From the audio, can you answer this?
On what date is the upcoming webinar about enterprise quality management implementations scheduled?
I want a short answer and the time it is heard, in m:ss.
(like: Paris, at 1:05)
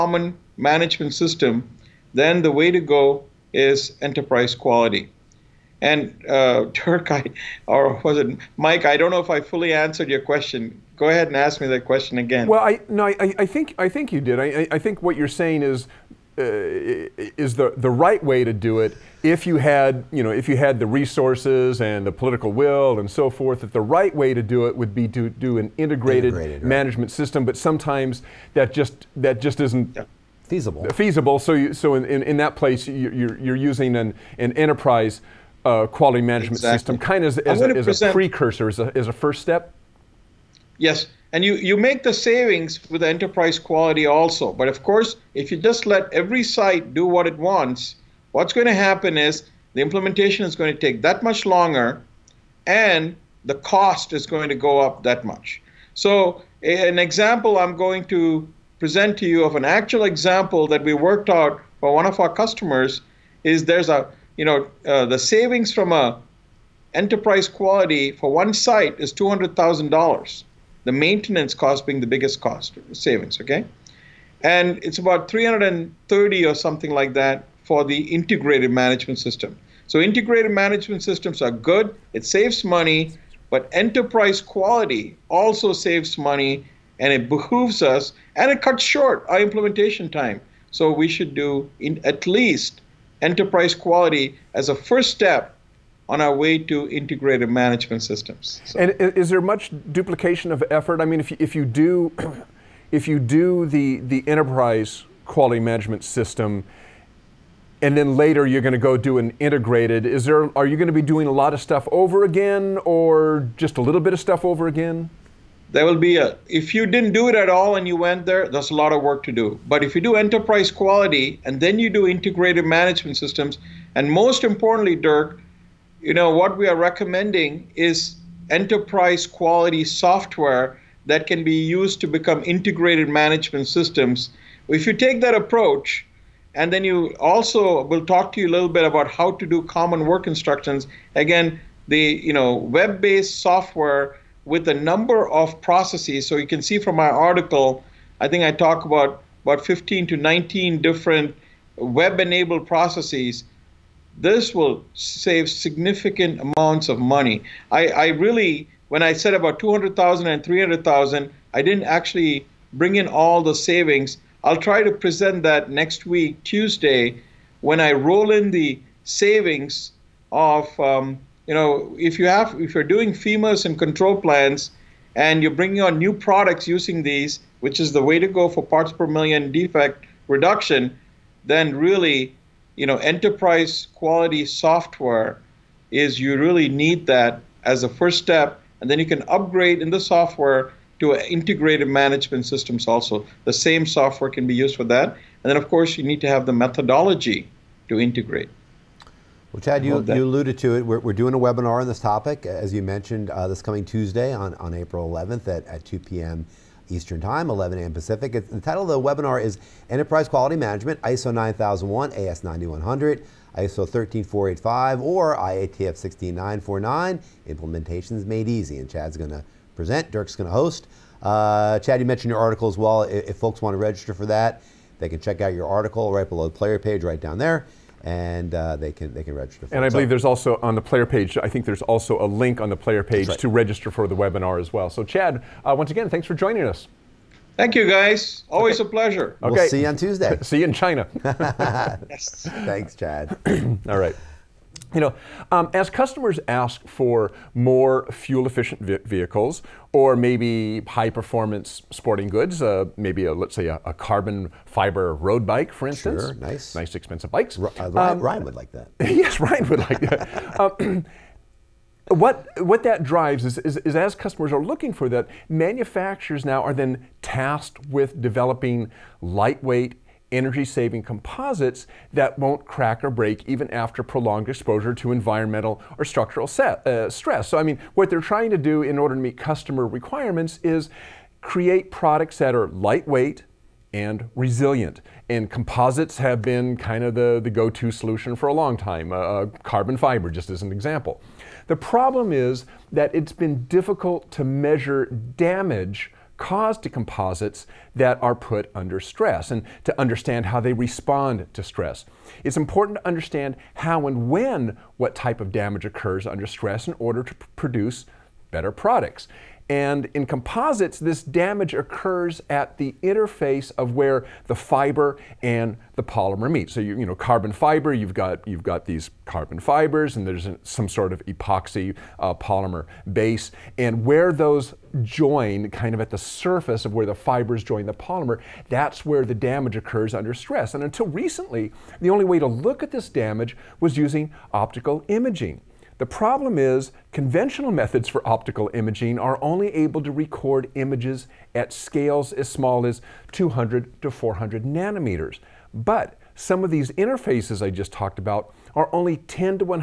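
April 11th, at 3:24.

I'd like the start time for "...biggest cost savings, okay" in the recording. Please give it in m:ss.
1:12.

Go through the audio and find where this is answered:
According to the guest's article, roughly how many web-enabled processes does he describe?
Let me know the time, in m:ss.
2:29.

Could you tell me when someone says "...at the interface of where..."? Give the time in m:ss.
5:12.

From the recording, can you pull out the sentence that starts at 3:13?
The same software can be used for that.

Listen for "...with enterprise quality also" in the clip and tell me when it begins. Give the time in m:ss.
0:42.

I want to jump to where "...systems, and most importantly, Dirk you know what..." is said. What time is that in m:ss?
2:03.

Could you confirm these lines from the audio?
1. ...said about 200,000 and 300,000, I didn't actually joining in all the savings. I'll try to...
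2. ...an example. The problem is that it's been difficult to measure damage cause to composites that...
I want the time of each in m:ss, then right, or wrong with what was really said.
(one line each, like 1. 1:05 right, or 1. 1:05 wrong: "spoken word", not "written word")
1. 2:39 wrong: "bring", not "joining"
2. 4:50 right.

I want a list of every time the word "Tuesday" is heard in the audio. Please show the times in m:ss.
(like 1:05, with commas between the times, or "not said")
2:46, 3:23, 3:59.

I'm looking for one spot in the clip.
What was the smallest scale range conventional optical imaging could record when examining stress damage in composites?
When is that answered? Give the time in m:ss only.
5:43.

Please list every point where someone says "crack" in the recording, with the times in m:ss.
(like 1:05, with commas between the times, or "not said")
4:32.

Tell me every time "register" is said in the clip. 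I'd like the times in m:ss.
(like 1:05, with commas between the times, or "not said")
3:43, 3:49, 3:53.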